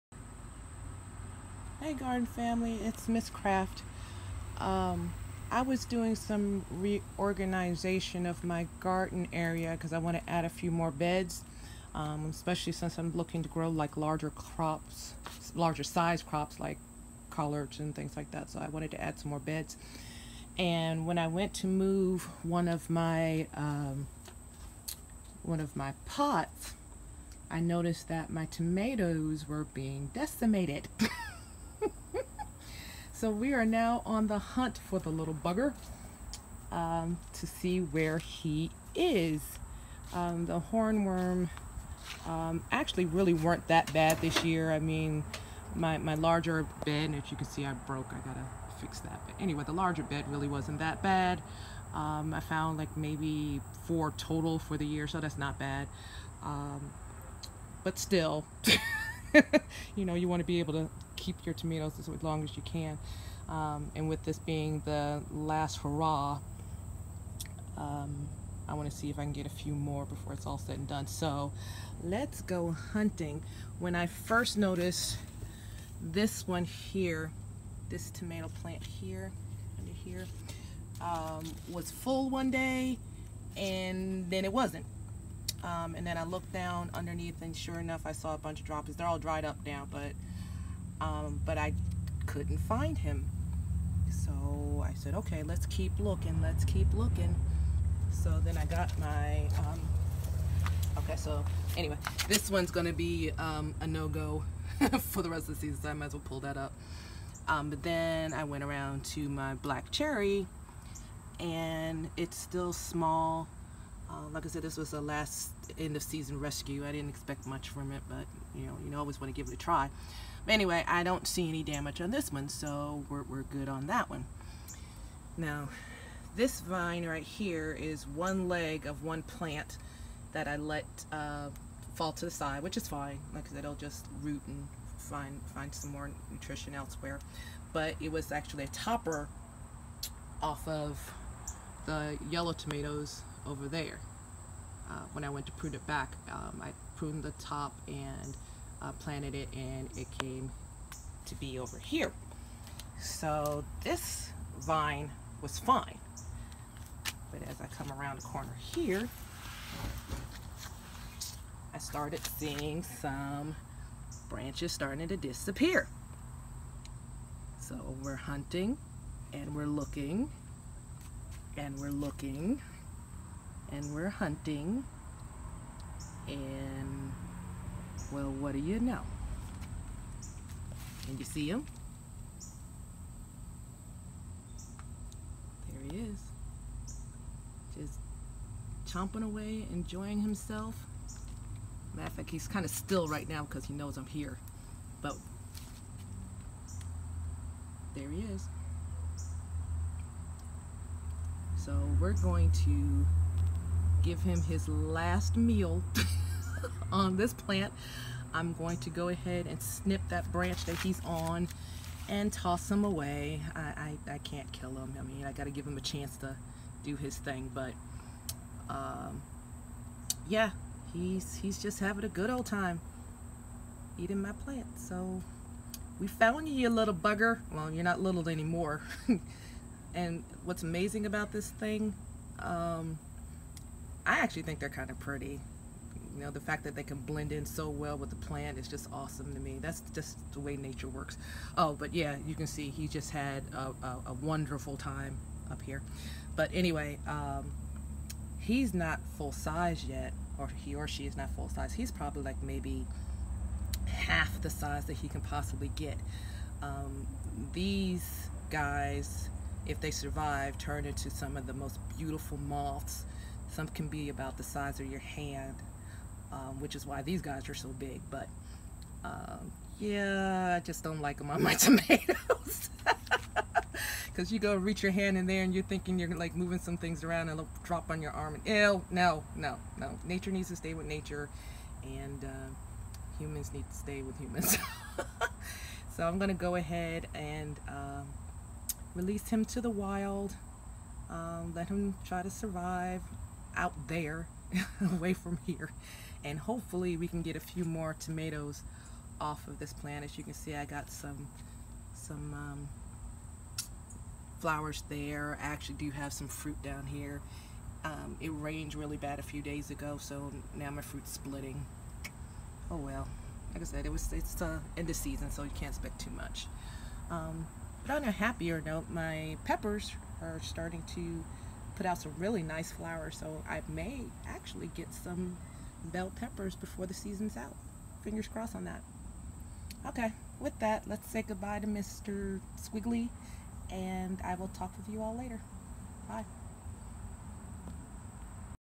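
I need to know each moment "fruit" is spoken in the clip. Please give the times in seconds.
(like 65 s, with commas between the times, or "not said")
306 s, 310 s.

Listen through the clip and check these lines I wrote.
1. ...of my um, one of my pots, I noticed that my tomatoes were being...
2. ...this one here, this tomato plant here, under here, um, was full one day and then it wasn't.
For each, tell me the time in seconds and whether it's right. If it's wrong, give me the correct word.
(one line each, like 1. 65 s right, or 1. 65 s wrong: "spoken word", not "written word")
1. 22 s right
2. 76 s right.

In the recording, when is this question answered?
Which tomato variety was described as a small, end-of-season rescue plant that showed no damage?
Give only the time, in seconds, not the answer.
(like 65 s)
109 s.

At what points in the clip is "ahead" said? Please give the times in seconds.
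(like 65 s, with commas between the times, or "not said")
209 s, 286 s.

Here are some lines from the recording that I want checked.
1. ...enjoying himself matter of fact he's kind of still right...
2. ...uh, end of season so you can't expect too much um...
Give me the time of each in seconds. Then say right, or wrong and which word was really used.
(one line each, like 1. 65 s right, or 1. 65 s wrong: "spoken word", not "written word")
1. 189 s right
2. 314 s right.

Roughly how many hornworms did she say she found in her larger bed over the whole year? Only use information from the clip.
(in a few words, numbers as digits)
4.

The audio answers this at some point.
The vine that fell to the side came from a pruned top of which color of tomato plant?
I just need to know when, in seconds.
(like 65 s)
142 s.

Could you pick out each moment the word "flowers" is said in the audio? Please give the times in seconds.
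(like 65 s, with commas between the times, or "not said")
304 s, 322 s.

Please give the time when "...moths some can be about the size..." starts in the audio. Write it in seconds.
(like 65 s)
262 s.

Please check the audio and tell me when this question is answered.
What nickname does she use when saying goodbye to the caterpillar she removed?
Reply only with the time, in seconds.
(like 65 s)
331 s.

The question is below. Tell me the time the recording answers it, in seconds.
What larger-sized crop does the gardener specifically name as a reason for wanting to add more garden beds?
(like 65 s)
17 s.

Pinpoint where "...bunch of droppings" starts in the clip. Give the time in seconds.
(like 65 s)
88 s.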